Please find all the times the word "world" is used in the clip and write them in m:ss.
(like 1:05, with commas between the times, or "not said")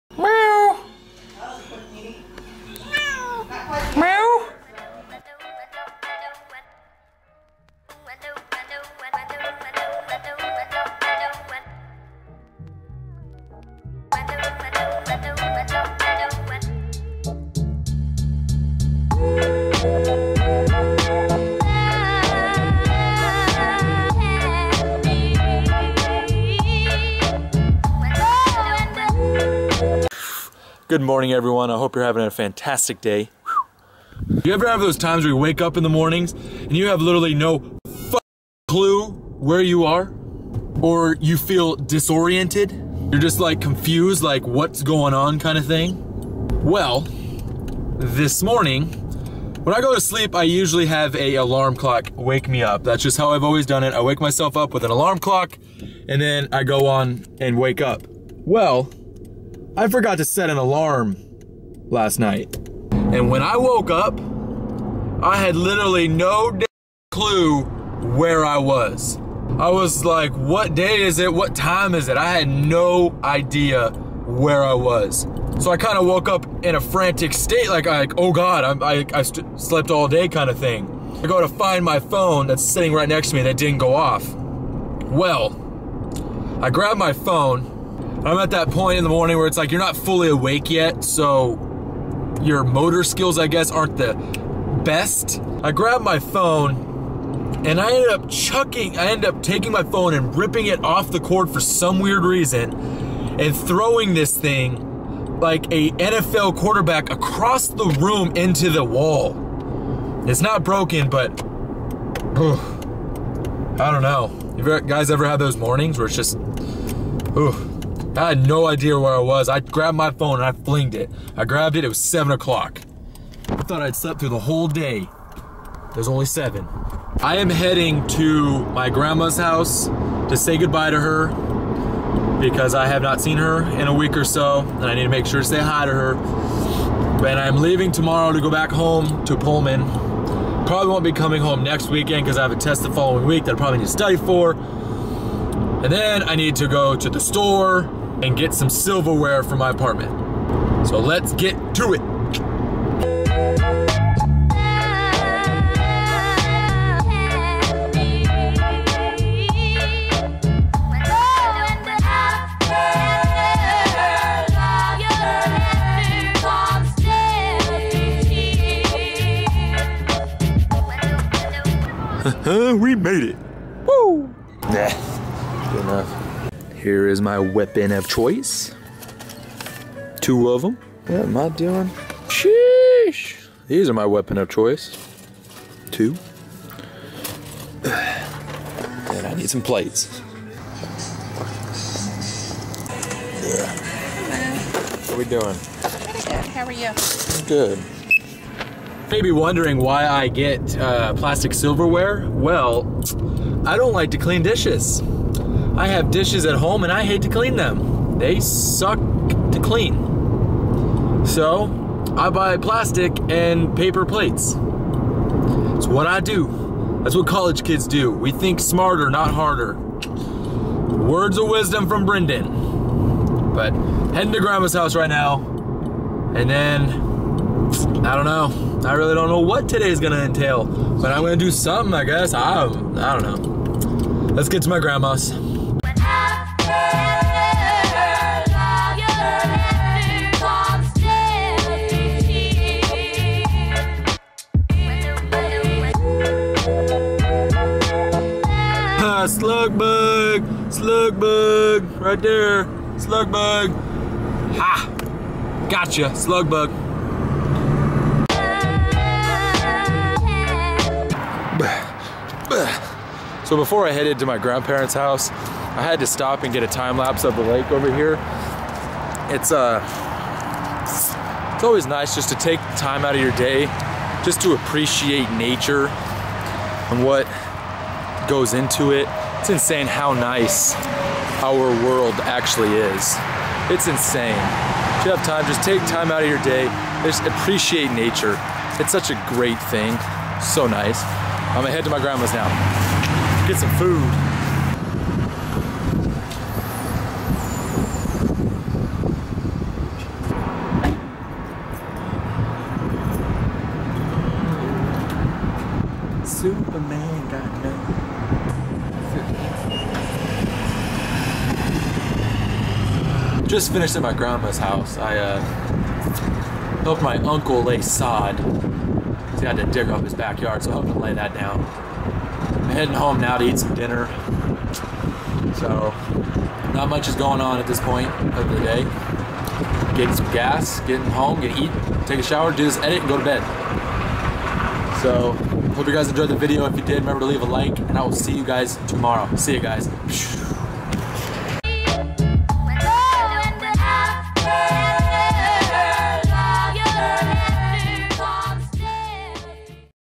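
4:41.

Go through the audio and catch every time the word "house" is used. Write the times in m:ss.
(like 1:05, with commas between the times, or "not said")
2:09, 3:44, 4:24, 5:14.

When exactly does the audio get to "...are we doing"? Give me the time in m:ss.
3:15.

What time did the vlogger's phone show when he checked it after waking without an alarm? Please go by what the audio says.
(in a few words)
7 o'clock.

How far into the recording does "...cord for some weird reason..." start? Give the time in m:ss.
1:41.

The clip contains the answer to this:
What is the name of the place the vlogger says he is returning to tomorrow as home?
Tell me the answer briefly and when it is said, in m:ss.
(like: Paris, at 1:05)
Pullman, at 2:19.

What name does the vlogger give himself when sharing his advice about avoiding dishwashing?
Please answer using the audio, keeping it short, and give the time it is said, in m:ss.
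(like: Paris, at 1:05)
Brenden, at 3:42.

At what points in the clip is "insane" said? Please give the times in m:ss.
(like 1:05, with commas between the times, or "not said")
4:39, 4:43.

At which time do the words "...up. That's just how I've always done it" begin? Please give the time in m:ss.
0:52.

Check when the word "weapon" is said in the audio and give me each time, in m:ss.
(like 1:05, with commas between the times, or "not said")
2:57, 3:04.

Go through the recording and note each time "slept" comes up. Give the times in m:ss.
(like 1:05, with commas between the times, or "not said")
1:19, 2:03.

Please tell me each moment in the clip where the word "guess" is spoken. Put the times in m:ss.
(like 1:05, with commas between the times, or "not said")
1:33, 3:52.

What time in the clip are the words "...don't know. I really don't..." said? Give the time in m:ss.
3:48.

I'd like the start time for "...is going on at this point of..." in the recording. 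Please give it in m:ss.
5:27.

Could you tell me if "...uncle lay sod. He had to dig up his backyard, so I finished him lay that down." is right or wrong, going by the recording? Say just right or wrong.
wrong.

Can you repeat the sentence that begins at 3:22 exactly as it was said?
Well, I don't like to clean dishes.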